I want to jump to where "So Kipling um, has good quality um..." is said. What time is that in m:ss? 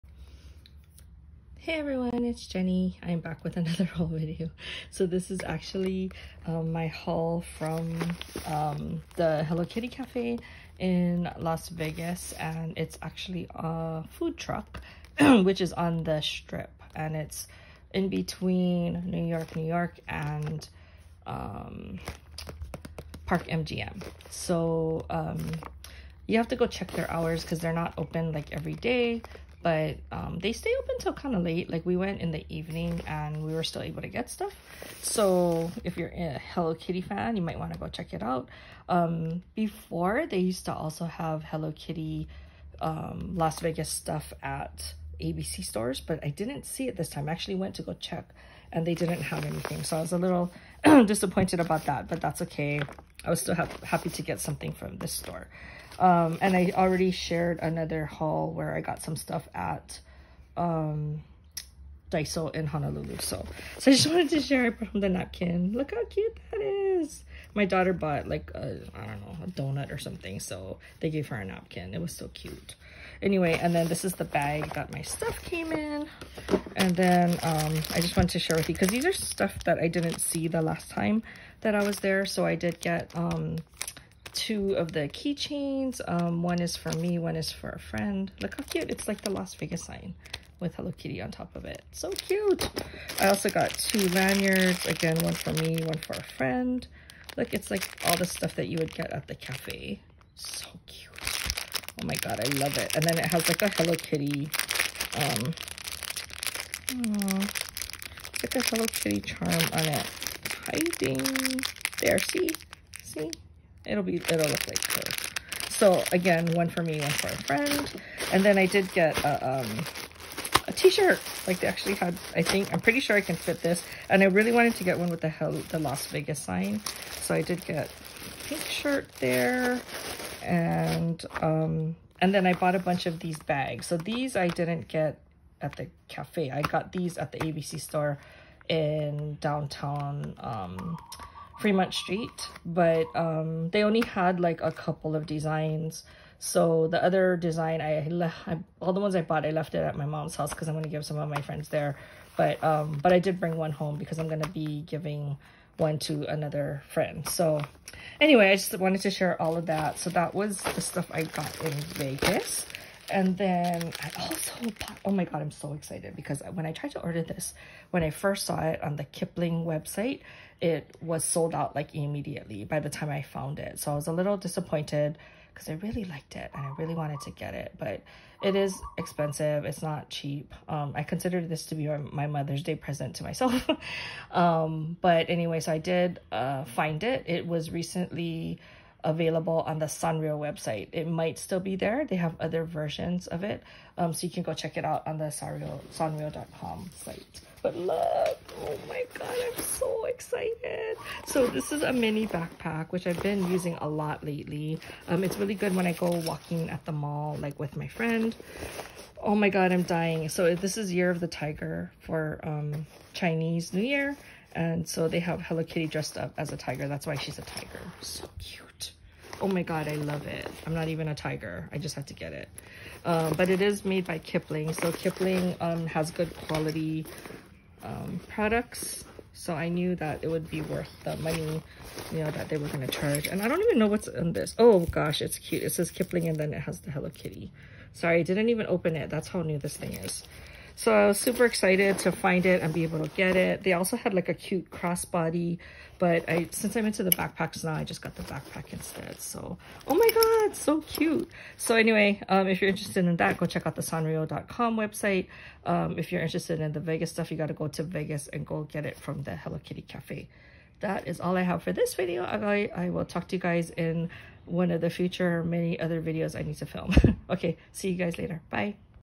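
3:44.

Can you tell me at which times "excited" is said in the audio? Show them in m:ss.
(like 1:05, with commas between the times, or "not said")
2:45, 3:20, 4:01.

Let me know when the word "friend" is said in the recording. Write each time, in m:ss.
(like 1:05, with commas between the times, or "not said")
1:27, 1:36, 1:57, 2:31, 2:36, 3:27.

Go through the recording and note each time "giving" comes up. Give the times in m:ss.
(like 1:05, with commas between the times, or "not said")
2:34.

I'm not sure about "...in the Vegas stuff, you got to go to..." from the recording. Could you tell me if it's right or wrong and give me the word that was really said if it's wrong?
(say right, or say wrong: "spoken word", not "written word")
right.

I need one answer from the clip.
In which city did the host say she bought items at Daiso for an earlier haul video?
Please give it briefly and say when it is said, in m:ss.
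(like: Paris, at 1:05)
Honolulu, at 1:02.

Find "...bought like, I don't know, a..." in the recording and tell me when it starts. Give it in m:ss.
1:07.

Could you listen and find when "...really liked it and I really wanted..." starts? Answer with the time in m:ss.
2:55.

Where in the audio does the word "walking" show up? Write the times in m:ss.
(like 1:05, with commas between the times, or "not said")
3:26.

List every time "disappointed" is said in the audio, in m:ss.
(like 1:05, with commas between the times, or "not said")
0:51, 2:54.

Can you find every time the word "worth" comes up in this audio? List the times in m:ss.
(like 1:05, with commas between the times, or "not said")
3:50.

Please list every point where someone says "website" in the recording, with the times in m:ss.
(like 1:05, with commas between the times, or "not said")
2:49, 3:10, 4:14.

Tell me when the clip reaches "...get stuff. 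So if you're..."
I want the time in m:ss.
0:34.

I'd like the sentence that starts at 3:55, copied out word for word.
It says Kipling and then it has the Hello Kitty.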